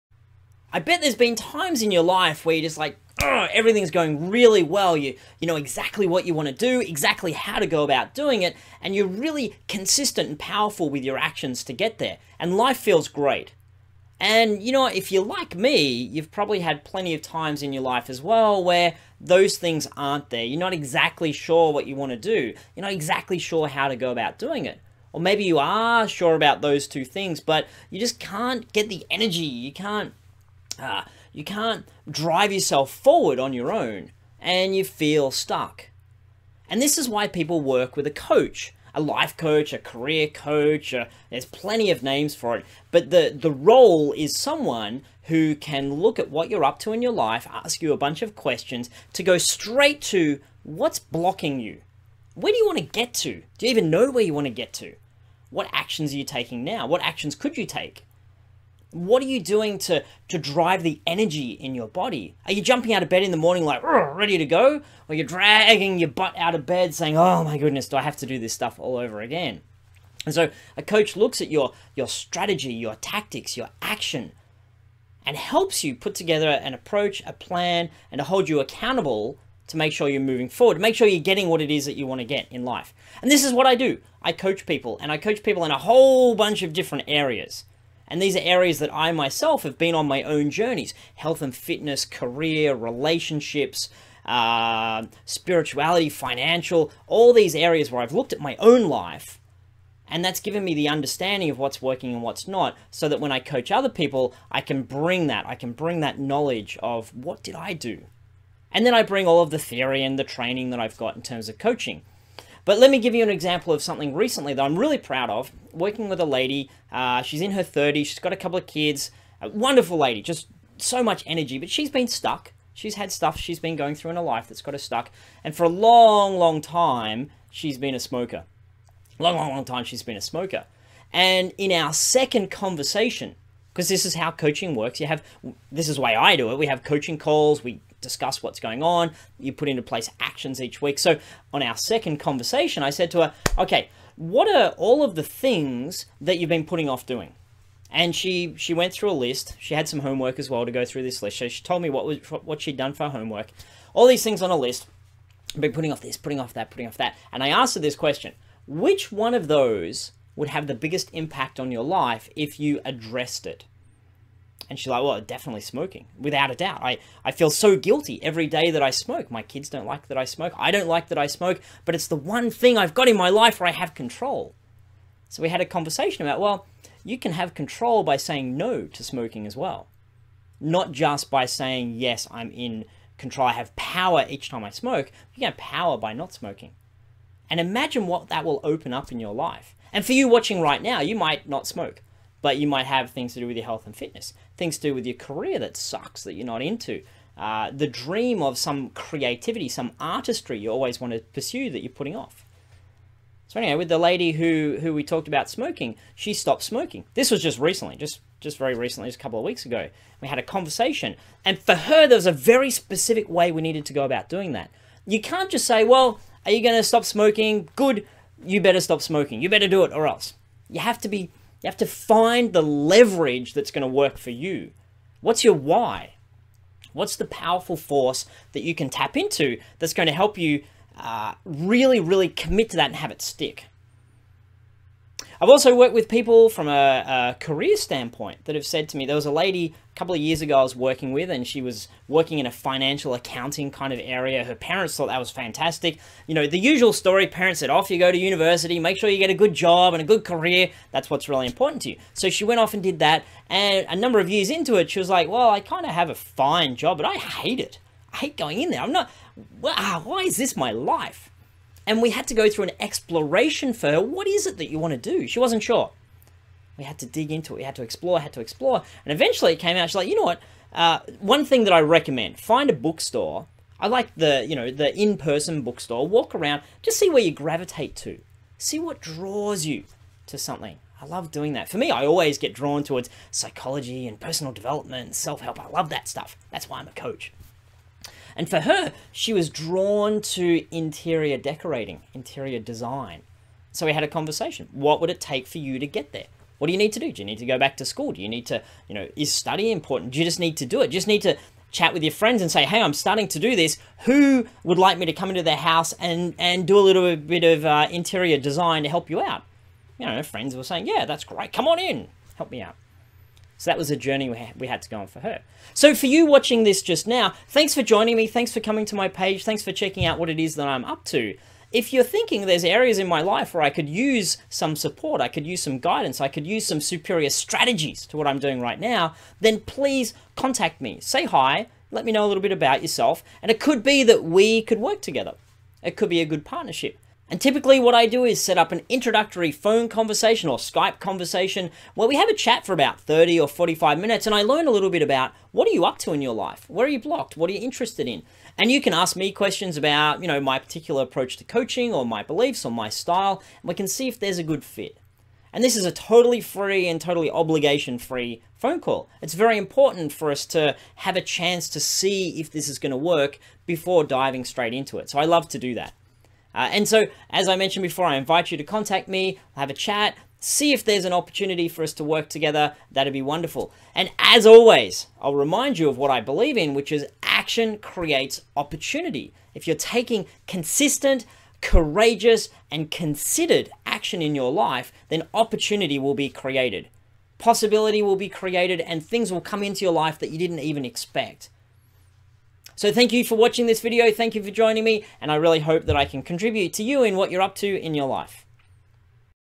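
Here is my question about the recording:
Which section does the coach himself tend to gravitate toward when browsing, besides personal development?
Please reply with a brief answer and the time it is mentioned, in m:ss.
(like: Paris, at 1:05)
Psychology, at 4:43.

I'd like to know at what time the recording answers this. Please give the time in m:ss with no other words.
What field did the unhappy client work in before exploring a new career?
4:02.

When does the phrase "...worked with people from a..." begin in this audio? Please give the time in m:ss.
3:55.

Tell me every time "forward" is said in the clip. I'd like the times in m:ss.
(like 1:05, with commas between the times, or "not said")
0:32, 1:20.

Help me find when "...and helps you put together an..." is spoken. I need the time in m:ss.
1:15.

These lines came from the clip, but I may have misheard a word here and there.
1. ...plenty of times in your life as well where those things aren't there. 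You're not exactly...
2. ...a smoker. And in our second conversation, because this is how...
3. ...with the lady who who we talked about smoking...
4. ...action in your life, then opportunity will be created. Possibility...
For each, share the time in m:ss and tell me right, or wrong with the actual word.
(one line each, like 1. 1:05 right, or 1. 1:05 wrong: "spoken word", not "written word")
1. 0:16 right
2. 2:10 right
3. 3:23 right
4. 6:23 right.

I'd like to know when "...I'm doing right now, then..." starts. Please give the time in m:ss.
5:28.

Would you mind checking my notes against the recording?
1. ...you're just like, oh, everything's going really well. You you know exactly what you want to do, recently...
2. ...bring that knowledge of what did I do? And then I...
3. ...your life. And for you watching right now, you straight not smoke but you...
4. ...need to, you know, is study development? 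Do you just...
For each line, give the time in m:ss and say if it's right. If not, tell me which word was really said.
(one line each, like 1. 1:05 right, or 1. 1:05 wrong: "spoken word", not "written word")
1. 0:02 wrong: "exactly", not "recently"
2. 1:45 right
3. 3:09 wrong: "might", not "straight"
4. 4:58 wrong: "important", not "development".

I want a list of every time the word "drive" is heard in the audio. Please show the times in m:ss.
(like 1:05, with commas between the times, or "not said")
0:32, 1:00.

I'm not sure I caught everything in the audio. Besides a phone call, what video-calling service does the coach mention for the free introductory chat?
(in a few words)
Skype.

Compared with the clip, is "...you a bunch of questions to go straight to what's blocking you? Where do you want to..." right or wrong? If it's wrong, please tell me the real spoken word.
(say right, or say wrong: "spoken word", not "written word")
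right.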